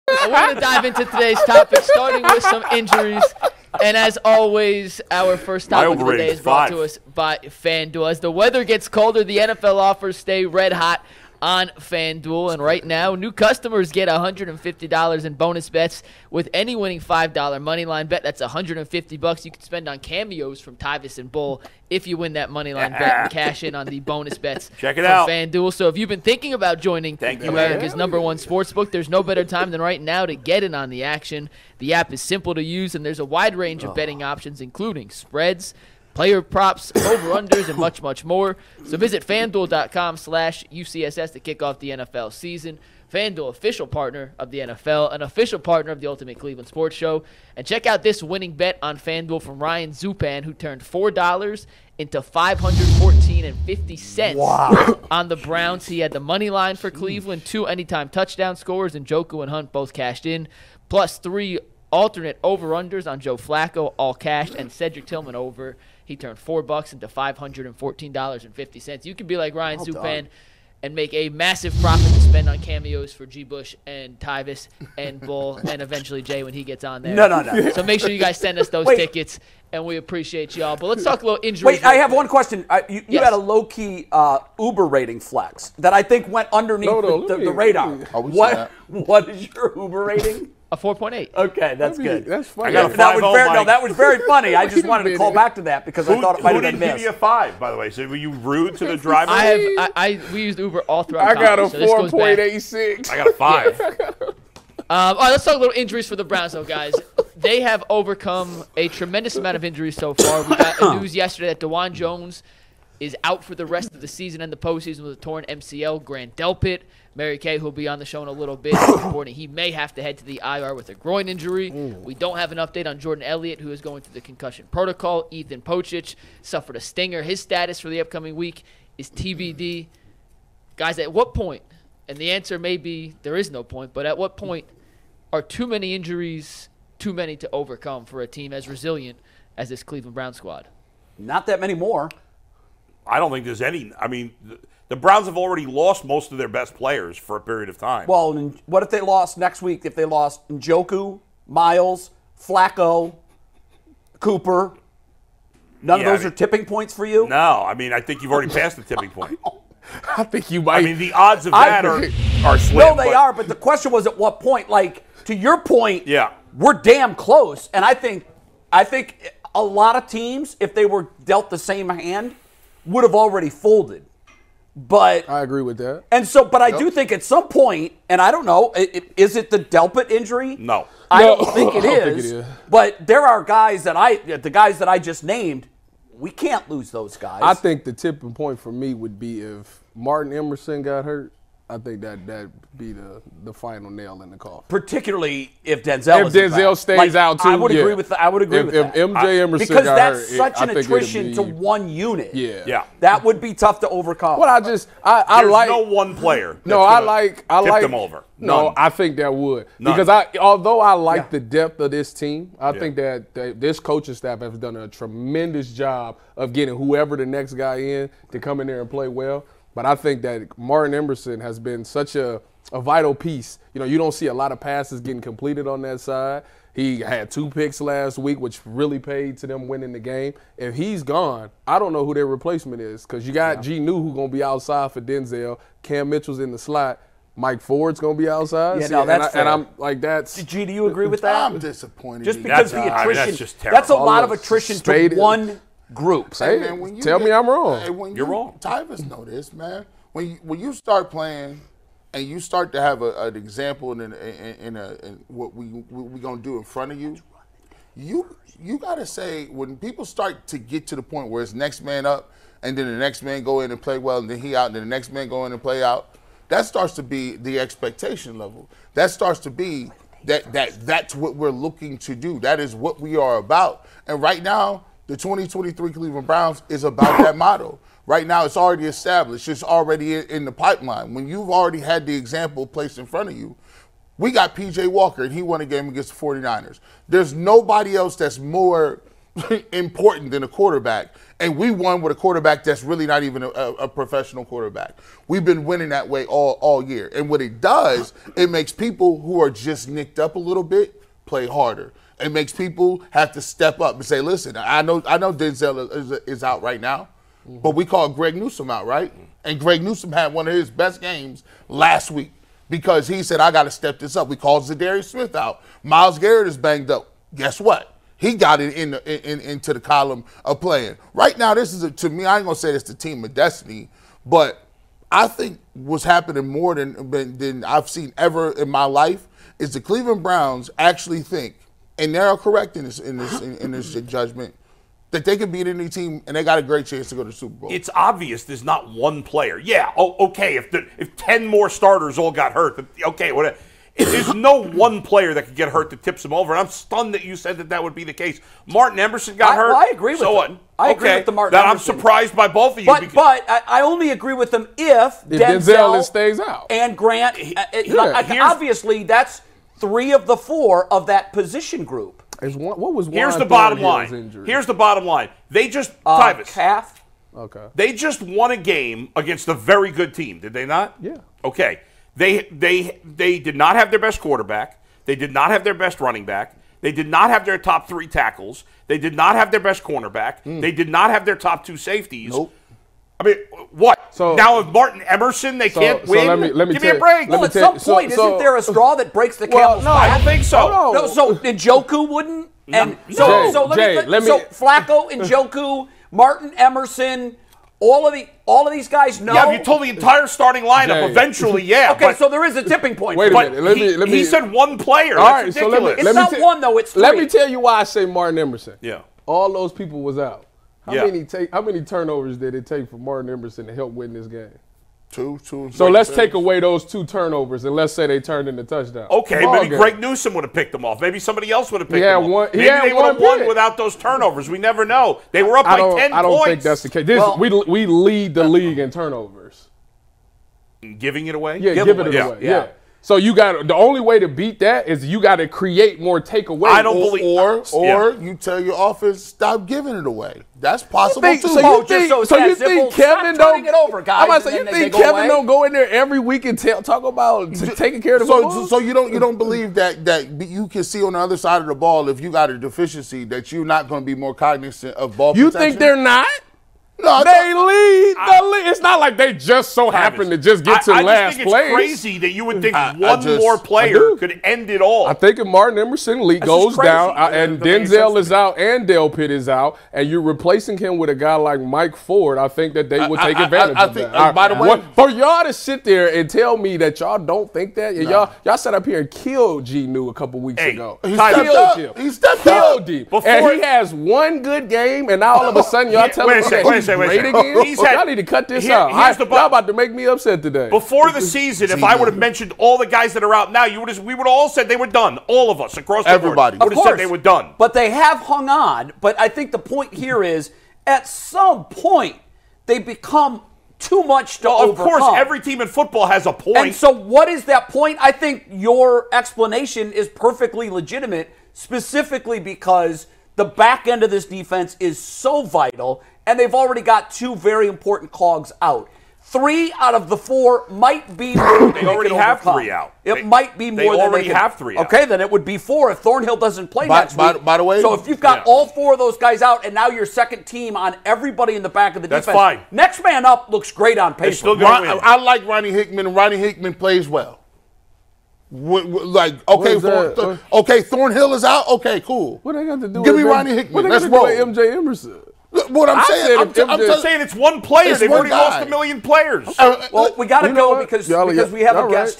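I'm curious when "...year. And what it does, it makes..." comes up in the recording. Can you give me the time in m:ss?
4:56.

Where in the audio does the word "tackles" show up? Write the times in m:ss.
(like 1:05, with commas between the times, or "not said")
6:18.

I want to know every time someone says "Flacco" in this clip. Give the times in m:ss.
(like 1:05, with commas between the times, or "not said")
1:03, 2:32, 6:34.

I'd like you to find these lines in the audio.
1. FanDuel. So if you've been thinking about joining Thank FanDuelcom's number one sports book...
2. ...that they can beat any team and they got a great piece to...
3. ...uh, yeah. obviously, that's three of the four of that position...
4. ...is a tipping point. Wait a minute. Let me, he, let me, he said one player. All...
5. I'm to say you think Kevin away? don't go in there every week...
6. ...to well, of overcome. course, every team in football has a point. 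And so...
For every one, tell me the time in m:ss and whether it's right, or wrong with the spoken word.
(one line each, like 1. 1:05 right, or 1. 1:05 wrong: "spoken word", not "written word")
1. 0:25 wrong: "America", not "FanDuelcom"
2. 5:35 wrong: "chance", not "piece"
3. 5:57 right
4. 6:42 right
5. 7:24 right
6. 8:24 right.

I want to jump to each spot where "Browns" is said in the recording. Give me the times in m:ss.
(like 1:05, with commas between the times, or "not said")
0:55, 1:46, 2:20, 2:24, 4:36, 5:30.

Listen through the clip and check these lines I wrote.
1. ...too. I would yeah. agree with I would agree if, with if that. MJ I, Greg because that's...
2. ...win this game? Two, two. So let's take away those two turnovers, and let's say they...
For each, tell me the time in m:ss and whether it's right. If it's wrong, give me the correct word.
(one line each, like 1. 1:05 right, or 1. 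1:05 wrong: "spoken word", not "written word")
1. 3:17 wrong: "Emerson", not "Greg"
2. 6:53 right.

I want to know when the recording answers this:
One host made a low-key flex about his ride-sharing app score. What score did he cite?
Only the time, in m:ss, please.
1:30.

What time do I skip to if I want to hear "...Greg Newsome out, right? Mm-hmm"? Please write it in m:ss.
5:08.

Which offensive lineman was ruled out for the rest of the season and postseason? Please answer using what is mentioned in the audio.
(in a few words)
Dawand Jones.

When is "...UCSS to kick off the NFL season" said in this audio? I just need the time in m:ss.
0:40.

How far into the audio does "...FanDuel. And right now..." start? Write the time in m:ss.
0:11.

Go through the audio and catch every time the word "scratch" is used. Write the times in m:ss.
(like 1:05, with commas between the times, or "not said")
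not said.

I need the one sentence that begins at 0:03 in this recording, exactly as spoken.
And as always, our first topic of the day is brought five.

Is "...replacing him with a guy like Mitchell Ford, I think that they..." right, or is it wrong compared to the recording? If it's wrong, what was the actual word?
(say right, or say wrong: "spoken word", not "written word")
wrong: "Mike", not "Mitchell".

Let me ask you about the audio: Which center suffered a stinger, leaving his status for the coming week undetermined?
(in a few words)
Ethan Pocic.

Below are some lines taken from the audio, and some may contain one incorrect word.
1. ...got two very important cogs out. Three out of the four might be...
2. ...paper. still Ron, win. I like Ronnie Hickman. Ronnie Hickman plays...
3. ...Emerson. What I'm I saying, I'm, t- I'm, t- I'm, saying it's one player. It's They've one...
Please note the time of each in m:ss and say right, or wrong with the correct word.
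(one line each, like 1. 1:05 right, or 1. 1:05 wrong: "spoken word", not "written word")
1. 8:36 right
2. 8:54 right
3. 9:04 right.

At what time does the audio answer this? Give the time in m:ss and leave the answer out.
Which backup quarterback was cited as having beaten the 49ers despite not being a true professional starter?
4:44.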